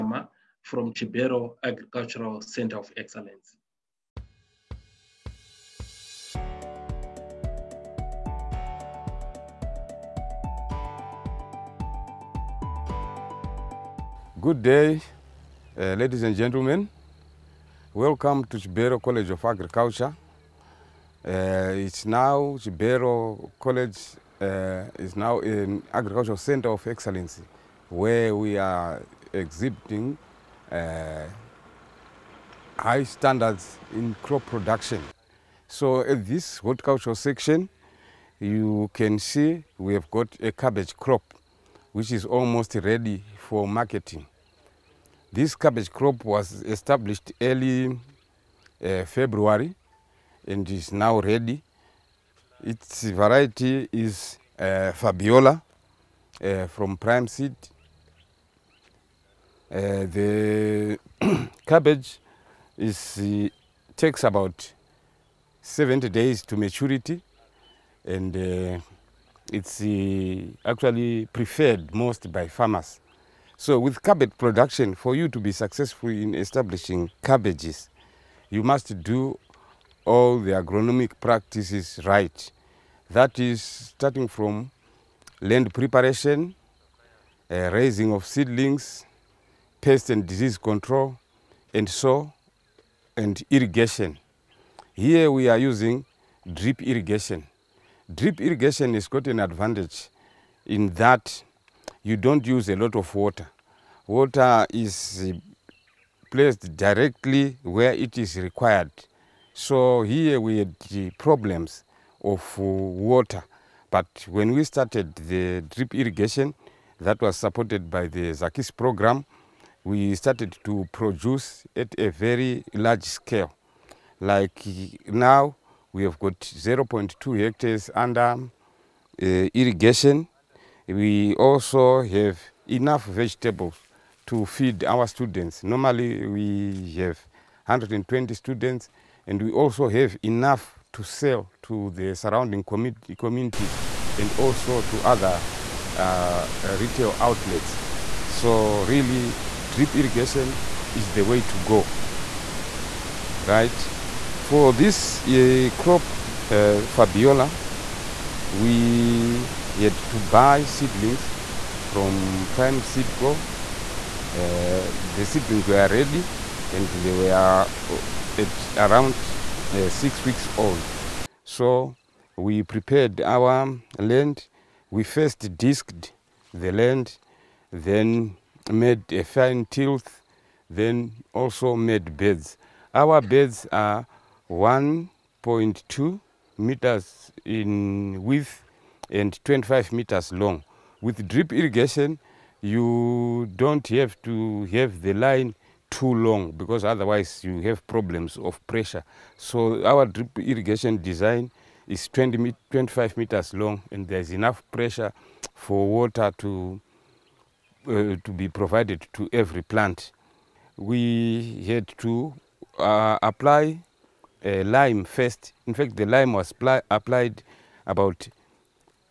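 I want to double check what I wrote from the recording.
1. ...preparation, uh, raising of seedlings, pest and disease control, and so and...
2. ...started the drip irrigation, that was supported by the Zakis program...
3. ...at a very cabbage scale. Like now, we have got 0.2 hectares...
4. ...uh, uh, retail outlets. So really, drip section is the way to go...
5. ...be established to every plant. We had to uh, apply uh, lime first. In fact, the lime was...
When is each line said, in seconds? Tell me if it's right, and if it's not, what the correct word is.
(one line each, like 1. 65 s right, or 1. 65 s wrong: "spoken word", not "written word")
1. 85 s right
2. 114 s right
3. 121 s wrong: "large", not "cabbage"
4. 145 s wrong: "irrigation", not "section"
5. 208 s wrong: "provided", not "established".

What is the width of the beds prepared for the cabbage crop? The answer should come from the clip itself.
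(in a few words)
1.2 meters.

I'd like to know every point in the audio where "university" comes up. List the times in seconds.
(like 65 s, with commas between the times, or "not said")
not said.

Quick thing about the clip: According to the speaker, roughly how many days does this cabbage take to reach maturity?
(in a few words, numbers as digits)
70 days.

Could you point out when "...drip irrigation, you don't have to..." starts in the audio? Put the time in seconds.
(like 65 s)
191 s.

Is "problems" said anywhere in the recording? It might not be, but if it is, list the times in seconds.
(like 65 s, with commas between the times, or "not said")
111 s, 197 s.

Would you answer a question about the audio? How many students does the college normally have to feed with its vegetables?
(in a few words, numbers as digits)
120.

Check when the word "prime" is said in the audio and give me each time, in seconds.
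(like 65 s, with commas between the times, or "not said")
56 s, 162 s.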